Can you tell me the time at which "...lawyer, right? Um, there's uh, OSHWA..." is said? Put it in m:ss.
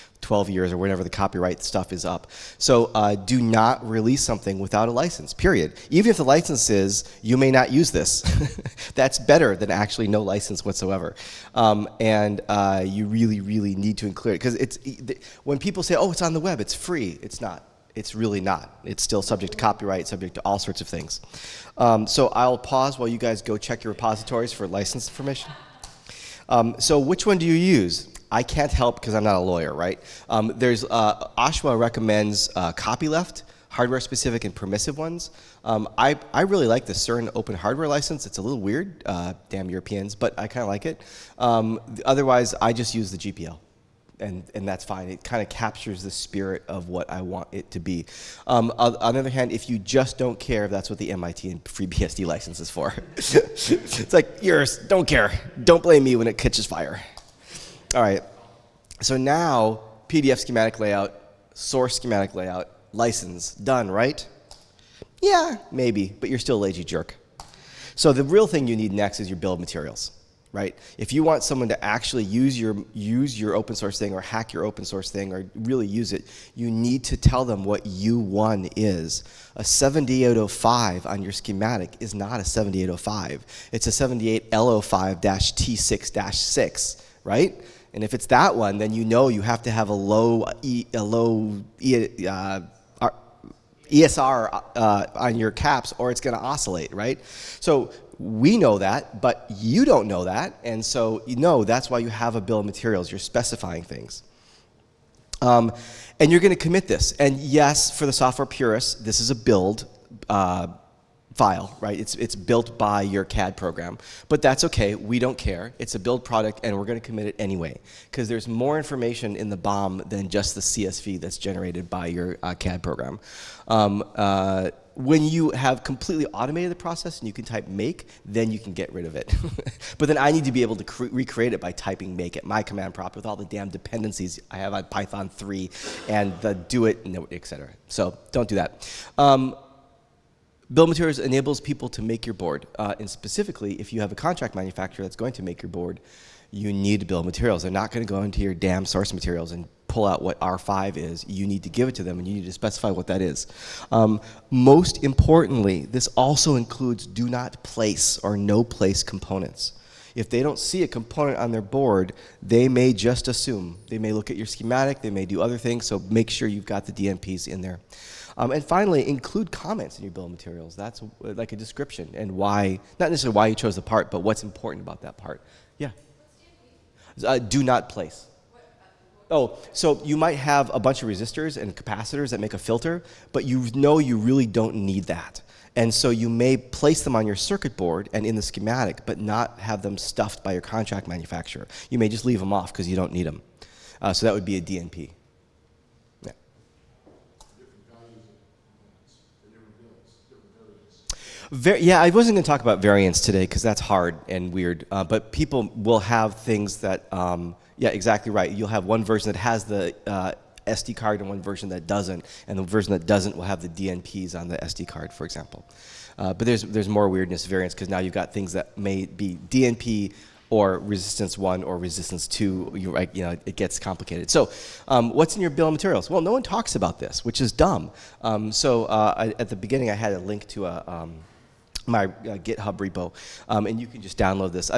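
0:29.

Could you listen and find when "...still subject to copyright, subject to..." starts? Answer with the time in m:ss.
0:19.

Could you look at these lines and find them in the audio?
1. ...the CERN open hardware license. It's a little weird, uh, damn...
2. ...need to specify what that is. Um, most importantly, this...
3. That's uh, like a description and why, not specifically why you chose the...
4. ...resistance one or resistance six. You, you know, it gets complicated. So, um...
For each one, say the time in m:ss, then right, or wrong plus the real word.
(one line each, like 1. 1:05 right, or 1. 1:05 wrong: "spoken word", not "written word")
1. 0:36 right
2. 2:32 right
3. 2:50 wrong: "necessarily", not "specifically"
4. 3:40 wrong: "two", not "six".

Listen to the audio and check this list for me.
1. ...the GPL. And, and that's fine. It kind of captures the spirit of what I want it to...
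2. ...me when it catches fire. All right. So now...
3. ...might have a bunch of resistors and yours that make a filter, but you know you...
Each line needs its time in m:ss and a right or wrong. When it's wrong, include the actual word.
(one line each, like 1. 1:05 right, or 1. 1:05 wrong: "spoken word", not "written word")
1. 0:43 right
2. 0:56 right
3. 3:00 wrong: "capacitors", not "yours".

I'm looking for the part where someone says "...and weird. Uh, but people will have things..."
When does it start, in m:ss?
3:24.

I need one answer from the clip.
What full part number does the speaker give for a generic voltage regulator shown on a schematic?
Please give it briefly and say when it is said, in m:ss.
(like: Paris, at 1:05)
78L05-T6-6, at 1:23.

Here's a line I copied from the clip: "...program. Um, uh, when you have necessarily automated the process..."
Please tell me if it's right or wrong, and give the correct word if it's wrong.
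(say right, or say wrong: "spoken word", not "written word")
wrong: "completely", not "necessarily".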